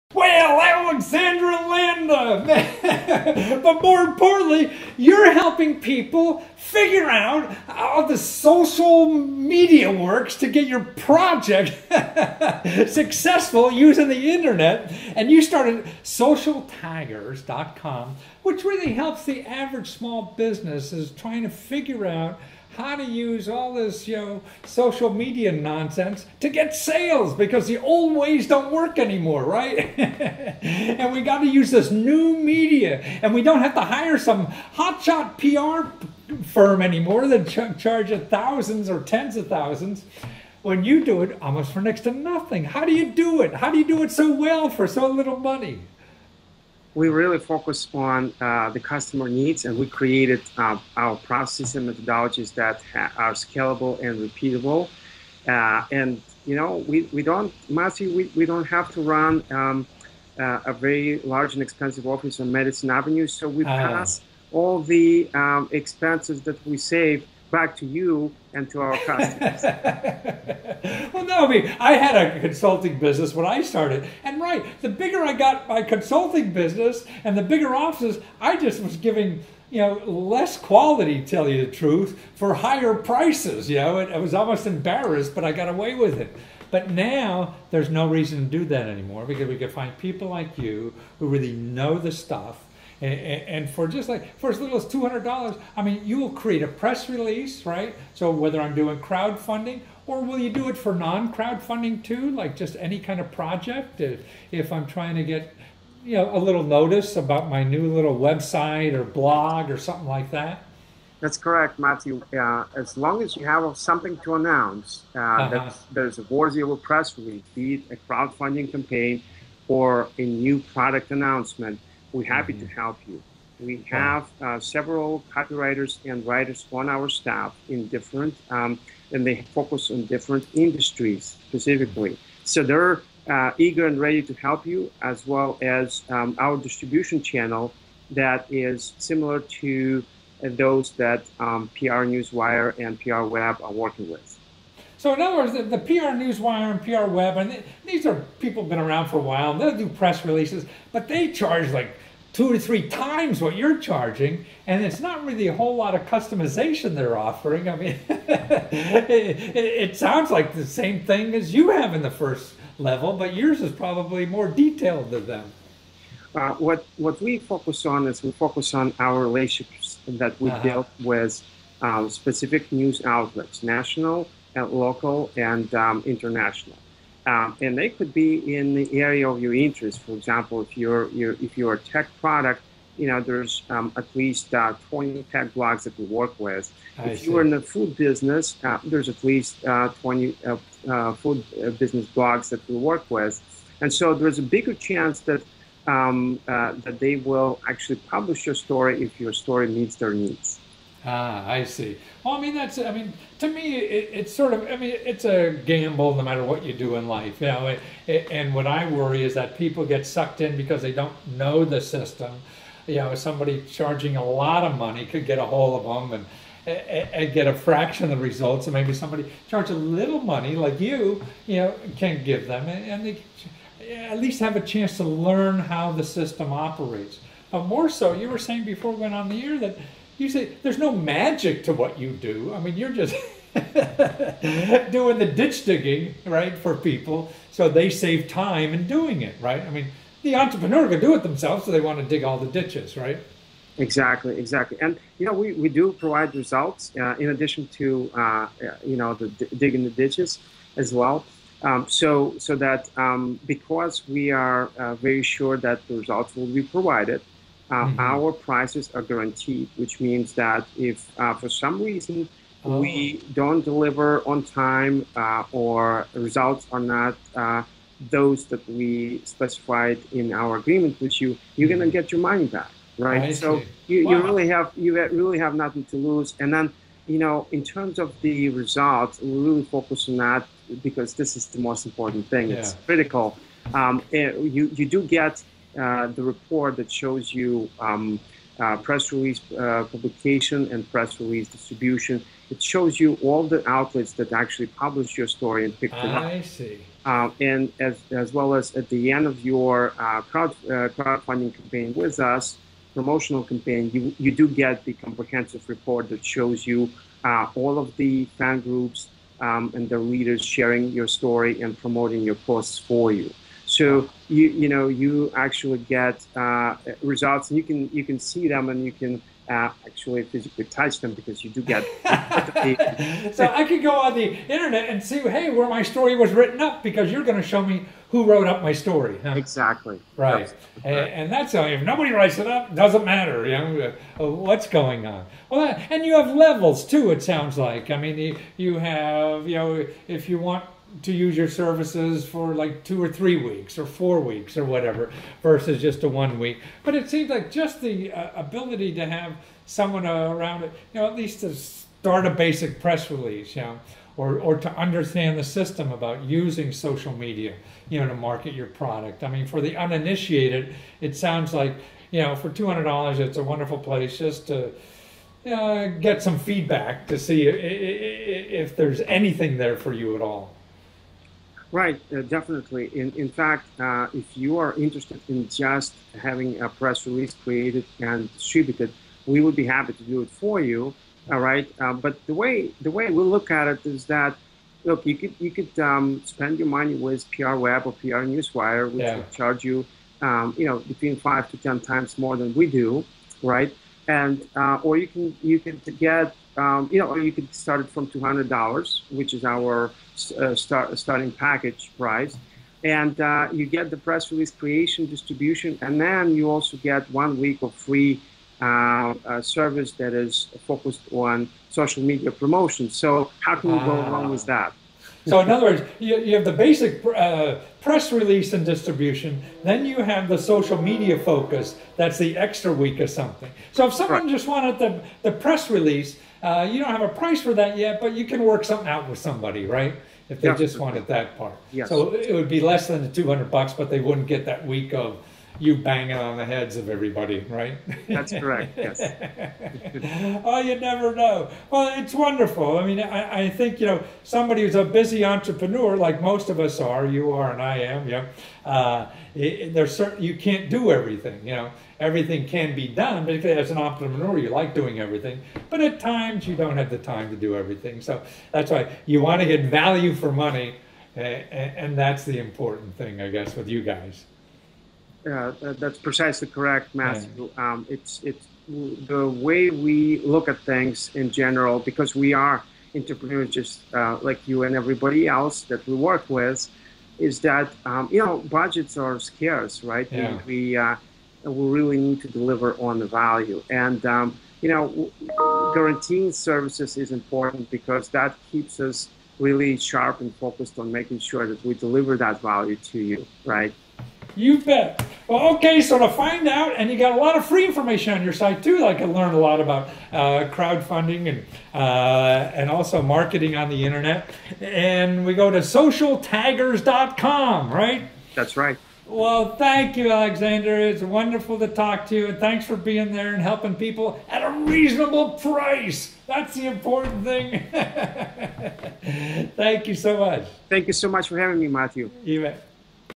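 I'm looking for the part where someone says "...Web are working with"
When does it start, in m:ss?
2:23.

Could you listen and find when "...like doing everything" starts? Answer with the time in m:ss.
7:34.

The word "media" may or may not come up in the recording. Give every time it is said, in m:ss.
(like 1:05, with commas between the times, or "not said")
0:09, 0:25, 0:32, 5:57, 6:52, 7:00.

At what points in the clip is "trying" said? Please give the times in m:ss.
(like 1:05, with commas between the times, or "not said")
0:21, 1:44.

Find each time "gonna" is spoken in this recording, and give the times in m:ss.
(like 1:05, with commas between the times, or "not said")
4:31.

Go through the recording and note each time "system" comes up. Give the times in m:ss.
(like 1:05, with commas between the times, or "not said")
3:31, 3:46, 5:55.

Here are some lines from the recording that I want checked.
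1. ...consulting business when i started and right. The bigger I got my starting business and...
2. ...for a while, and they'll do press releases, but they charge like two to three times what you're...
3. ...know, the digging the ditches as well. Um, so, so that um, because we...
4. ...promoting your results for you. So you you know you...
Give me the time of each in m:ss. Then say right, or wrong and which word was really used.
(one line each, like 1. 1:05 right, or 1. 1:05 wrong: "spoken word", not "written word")
1. 1:12 wrong: "consulting", not "starting"
2. 2:29 right
3. 4:08 right
4. 5:11 wrong: "posts", not "results".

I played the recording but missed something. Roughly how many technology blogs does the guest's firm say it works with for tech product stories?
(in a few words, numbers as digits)
20.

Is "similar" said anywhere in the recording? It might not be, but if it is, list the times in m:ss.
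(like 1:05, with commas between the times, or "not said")
2:18.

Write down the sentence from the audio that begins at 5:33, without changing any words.
You know, uh, uh, what's going on?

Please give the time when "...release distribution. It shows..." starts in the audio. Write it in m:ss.
4:51.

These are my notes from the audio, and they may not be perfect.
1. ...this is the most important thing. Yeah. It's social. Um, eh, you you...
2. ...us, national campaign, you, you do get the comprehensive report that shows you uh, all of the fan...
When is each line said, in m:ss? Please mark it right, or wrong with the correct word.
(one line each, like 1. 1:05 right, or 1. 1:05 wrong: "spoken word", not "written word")
1. 4:41 wrong: "critical", not "social"
2. 5:02 wrong: "promotional", not "national".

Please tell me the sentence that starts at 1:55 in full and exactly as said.
that there's a war of press release be it a crowdfunding campaign or a new product announcement we're happy mm-hmm.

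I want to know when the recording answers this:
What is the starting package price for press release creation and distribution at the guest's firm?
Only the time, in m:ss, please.
6:38.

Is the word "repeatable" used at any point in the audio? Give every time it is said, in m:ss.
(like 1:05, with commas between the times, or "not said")
0:54.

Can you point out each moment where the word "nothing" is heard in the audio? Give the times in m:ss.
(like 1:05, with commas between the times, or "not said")
0:42, 4:35.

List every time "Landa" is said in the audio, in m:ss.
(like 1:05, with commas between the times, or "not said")
0:01.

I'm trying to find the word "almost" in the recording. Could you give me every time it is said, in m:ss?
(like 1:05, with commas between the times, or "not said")
0:41, 1:24.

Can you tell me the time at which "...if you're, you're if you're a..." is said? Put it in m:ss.
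3:00.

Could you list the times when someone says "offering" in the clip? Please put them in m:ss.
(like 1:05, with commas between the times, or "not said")
2:37.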